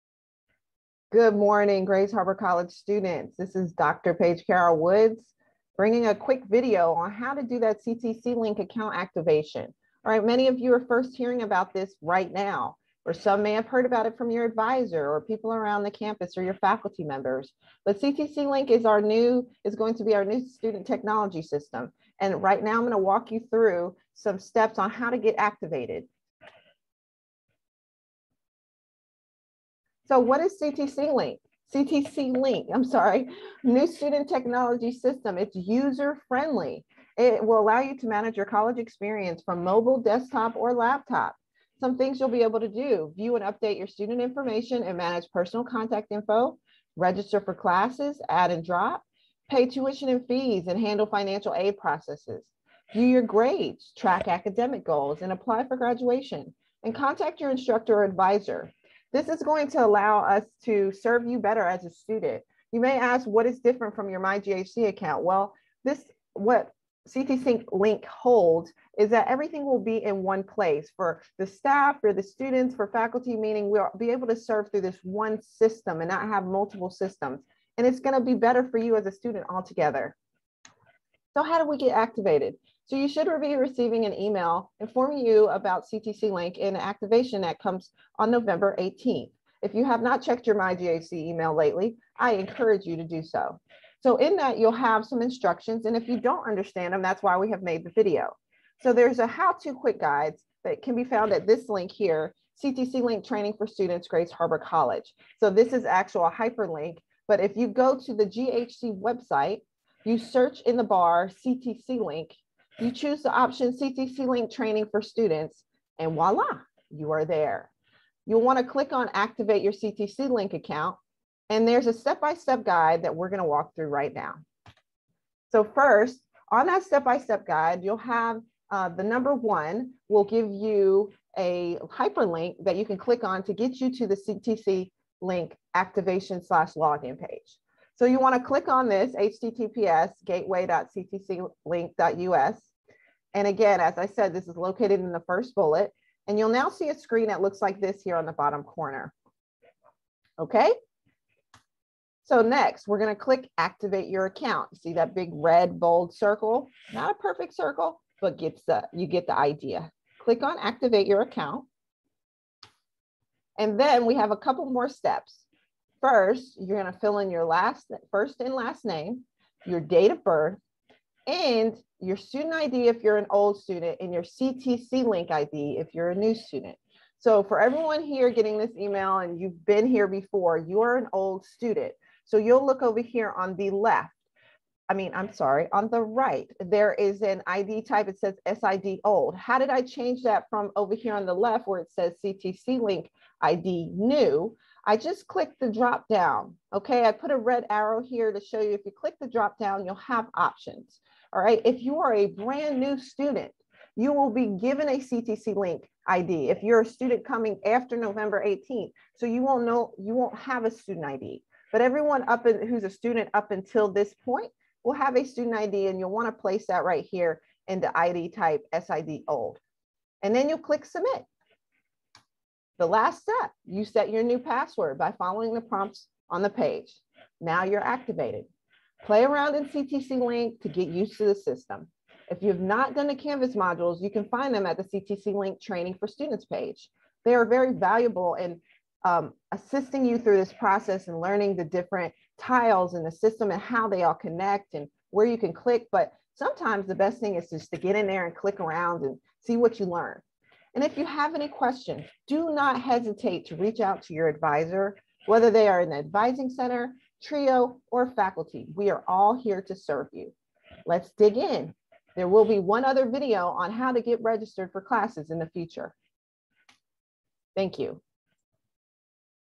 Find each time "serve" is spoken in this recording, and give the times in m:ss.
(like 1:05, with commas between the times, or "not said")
1:00, 1:14, 4:19.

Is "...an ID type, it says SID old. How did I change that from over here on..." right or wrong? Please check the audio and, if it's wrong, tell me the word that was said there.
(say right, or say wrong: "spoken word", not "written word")
right.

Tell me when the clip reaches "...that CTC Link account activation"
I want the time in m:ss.
0:07.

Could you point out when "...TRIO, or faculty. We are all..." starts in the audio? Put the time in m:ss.
4:17.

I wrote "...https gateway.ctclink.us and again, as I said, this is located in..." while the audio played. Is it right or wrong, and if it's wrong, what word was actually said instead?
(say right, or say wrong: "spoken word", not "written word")
right.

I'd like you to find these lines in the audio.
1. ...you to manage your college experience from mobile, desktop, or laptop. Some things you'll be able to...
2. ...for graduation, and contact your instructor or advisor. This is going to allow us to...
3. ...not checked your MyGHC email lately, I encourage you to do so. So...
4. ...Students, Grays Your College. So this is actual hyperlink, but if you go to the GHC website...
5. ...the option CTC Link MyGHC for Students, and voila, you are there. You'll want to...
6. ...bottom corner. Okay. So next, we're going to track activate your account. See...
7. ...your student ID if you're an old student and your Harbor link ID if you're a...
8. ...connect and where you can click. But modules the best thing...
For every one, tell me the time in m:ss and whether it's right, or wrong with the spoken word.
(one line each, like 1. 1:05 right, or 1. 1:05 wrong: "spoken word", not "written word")
1. 0:37 right
2. 0:55 right
3. 1:30 right
4. 1:43 wrong: "Harbor", not "Your"
5. 1:53 wrong: "Training", not "MyGHC"
6. 2:28 wrong: "click", not "track"
7. 2:51 wrong: "CTC", not "Harbor"
8. 4:04 wrong: "sometimes", not "modules".